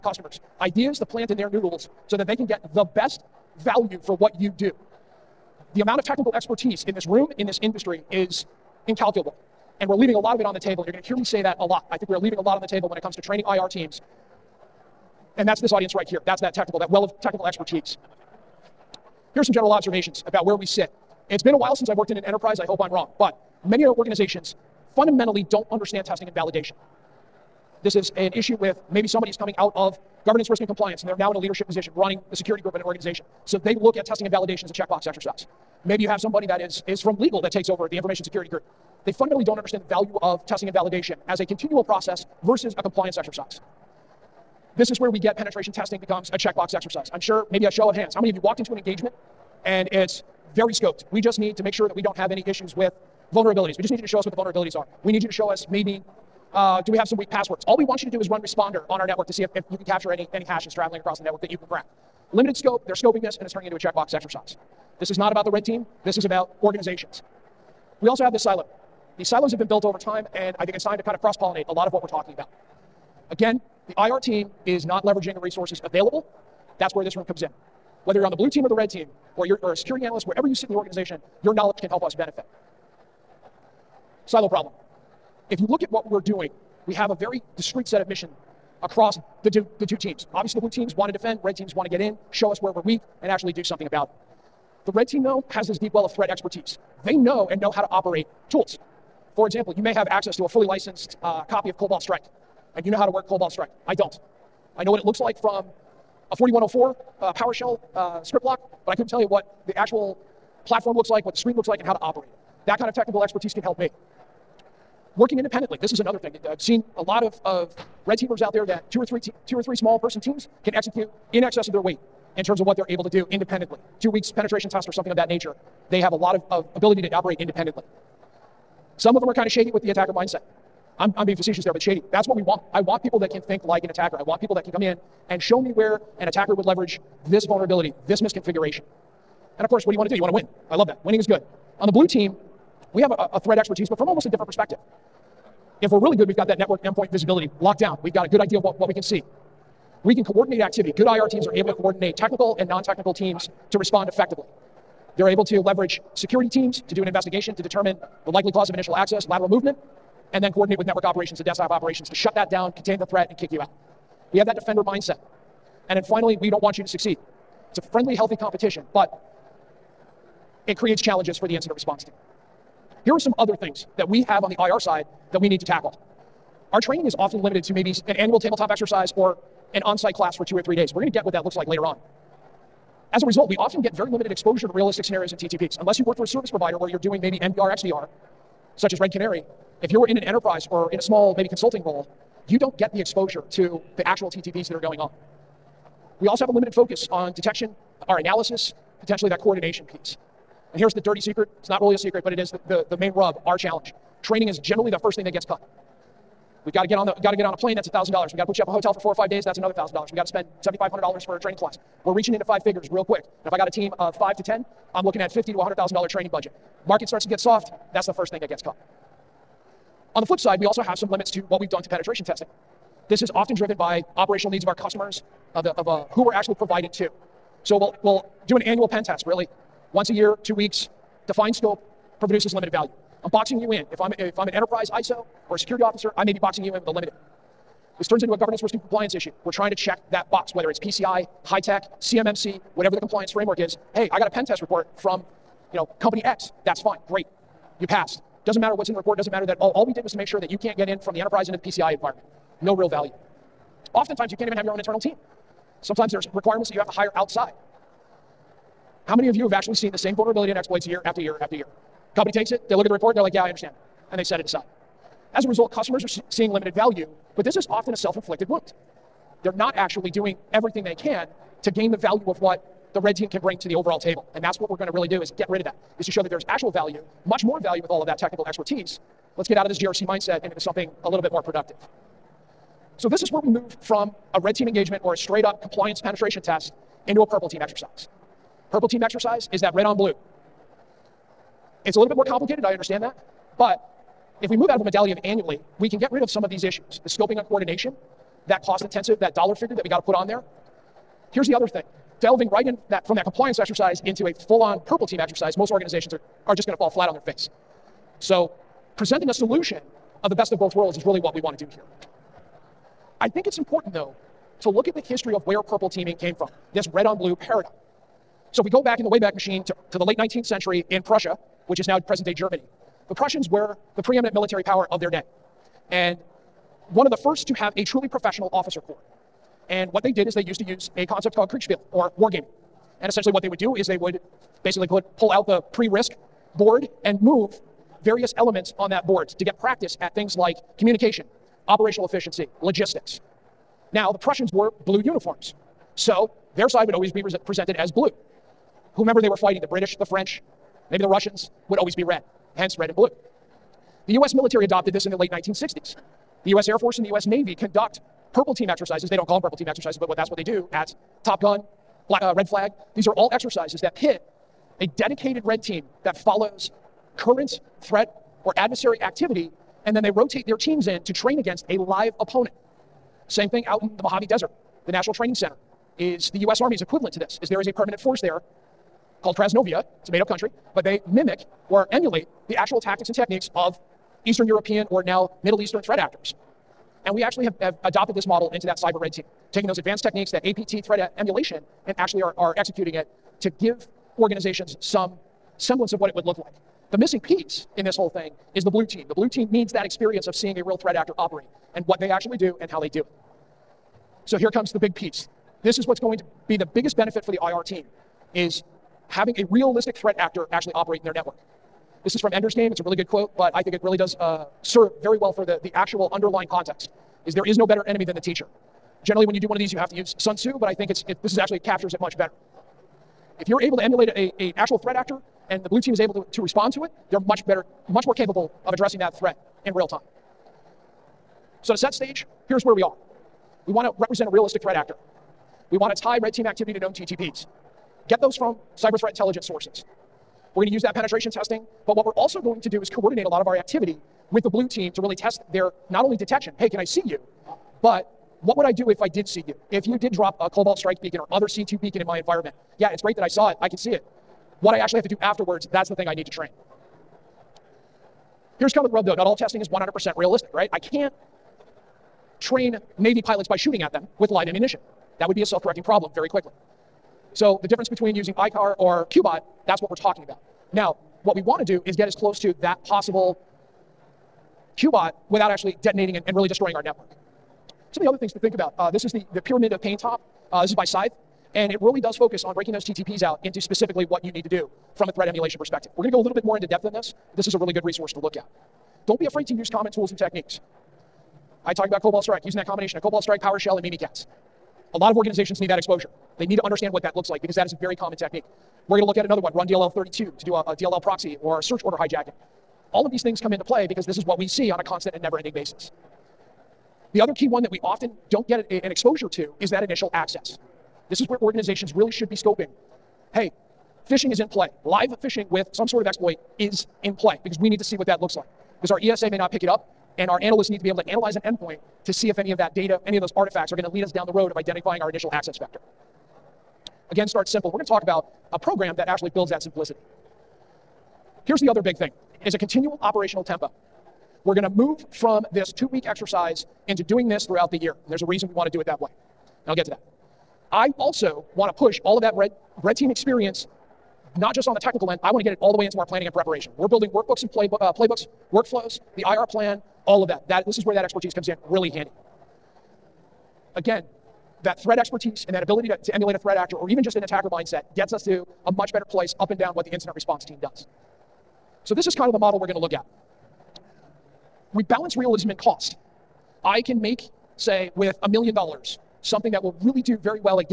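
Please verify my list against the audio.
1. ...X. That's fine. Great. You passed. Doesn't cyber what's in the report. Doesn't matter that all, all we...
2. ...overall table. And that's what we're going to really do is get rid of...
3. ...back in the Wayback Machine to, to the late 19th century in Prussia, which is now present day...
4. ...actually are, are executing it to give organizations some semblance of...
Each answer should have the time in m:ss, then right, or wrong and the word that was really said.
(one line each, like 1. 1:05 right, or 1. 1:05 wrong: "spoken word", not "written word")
1. 4:06 wrong: "matter", not "cyber"
2. 4:33 right
3. 5:18 right
4. 6:31 right.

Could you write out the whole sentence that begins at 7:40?
I can't train Navy pilots by shooting at them with live ammunition.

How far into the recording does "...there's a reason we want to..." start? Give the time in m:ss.
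8:58.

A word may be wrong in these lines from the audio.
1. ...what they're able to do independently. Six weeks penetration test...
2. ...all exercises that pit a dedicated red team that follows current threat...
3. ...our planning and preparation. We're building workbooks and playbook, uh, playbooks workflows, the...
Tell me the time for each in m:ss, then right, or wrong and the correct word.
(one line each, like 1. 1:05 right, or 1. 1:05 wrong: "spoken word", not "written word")
1. 2:02 wrong: "Two", not "Six"
2. 6:03 right
3. 9:05 right.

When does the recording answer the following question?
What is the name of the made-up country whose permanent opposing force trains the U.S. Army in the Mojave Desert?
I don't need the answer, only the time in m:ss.
6:19.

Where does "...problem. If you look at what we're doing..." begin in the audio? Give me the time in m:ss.
1:24.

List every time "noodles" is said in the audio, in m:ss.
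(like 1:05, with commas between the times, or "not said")
0:01.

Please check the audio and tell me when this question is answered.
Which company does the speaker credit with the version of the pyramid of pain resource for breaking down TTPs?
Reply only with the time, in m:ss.
8:00.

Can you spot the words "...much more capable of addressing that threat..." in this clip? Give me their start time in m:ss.
7:07.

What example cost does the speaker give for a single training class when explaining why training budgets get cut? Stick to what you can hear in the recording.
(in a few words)
$7,500.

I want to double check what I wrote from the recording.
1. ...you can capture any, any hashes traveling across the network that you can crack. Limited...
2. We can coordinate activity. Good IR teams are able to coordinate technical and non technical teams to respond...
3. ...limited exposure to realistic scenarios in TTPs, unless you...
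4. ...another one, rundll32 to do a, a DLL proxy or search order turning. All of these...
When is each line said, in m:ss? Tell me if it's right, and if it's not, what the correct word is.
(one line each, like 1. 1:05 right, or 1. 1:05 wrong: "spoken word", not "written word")
1. 0:59 right
2. 2:30 right
3. 3:04 right
4. 8:19 wrong: "hijacking", not "turning".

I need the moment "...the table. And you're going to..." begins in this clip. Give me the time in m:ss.
0:10.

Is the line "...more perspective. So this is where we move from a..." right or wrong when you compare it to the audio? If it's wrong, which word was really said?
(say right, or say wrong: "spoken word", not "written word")
wrong: "productive", not "perspective".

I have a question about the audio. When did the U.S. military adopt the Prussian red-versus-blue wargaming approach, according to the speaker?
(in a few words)
late 1960s.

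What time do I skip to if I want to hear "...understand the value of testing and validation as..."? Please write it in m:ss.
0:39.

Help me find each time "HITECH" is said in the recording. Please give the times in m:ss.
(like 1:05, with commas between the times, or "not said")
4:01.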